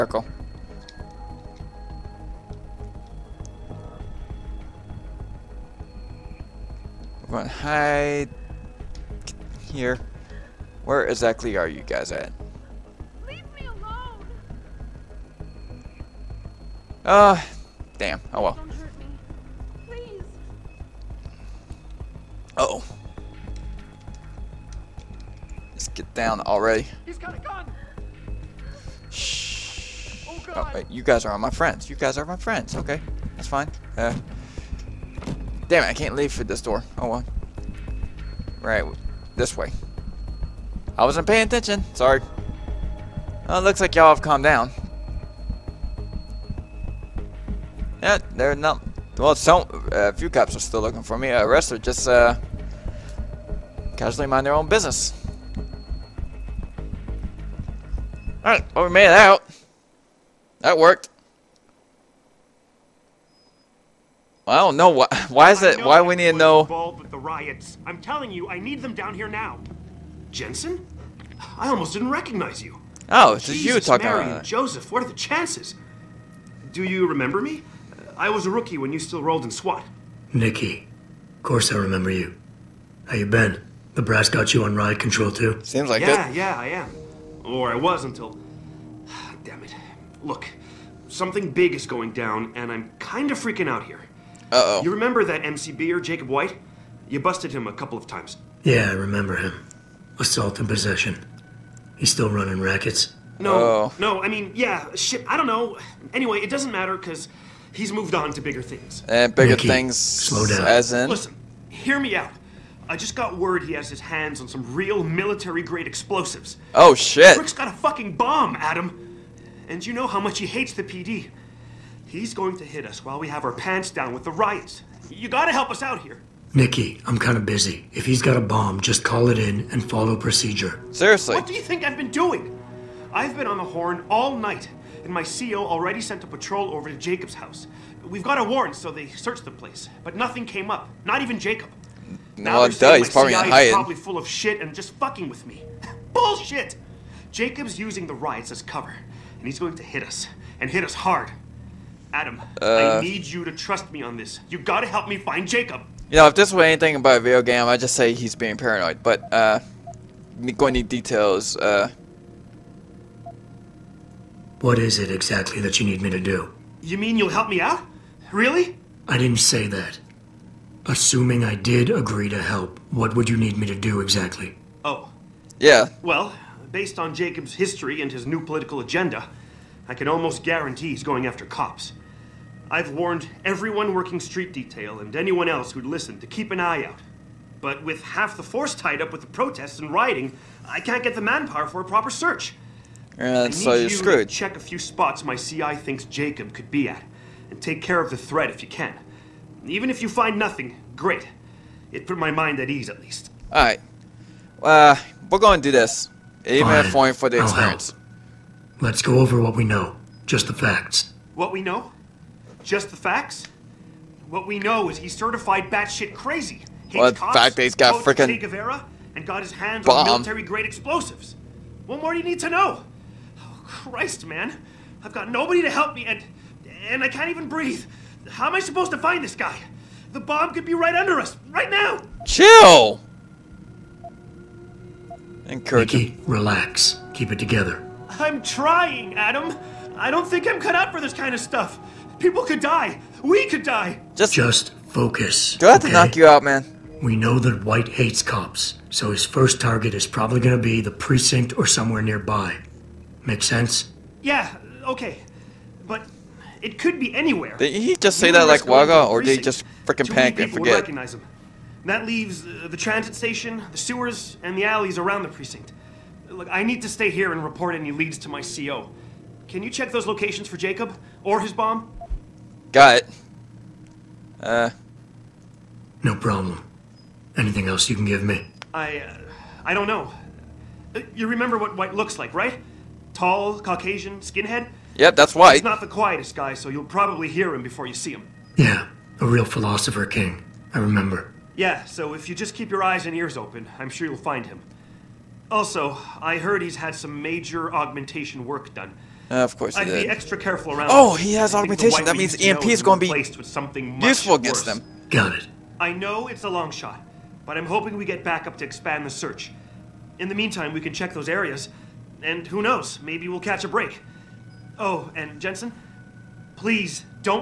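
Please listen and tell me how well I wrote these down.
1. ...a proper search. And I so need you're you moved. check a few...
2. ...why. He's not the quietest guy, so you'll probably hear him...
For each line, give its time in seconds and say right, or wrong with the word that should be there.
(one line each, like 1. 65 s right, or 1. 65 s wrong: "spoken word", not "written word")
1. 191 s wrong: "screwed", not "moved"
2. 285 s right.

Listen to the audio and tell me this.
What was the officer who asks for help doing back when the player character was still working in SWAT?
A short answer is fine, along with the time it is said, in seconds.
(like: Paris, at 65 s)
a rookie, at 78 s.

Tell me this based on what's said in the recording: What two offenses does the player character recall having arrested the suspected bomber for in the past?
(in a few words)
Assault and possession.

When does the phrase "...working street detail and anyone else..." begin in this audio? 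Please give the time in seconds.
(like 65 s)
183 s.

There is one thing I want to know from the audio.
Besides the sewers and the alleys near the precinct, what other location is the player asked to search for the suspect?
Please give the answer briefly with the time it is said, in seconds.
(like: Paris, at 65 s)
the transit station, at 262 s.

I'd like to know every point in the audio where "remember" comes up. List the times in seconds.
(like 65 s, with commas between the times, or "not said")
77 s, 81 s, 94 s, 98 s, 281 s, 290 s.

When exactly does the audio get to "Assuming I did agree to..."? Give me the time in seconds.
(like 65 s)
170 s.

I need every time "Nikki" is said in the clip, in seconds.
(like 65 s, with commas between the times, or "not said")
80 s, 126 s.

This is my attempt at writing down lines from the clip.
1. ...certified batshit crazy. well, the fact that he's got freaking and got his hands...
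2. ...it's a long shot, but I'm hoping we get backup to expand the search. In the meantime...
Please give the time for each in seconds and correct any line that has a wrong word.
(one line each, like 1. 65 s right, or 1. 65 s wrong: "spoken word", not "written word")
1. 215 s right
2. 306 s right.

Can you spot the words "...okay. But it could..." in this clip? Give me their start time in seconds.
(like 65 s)
254 s.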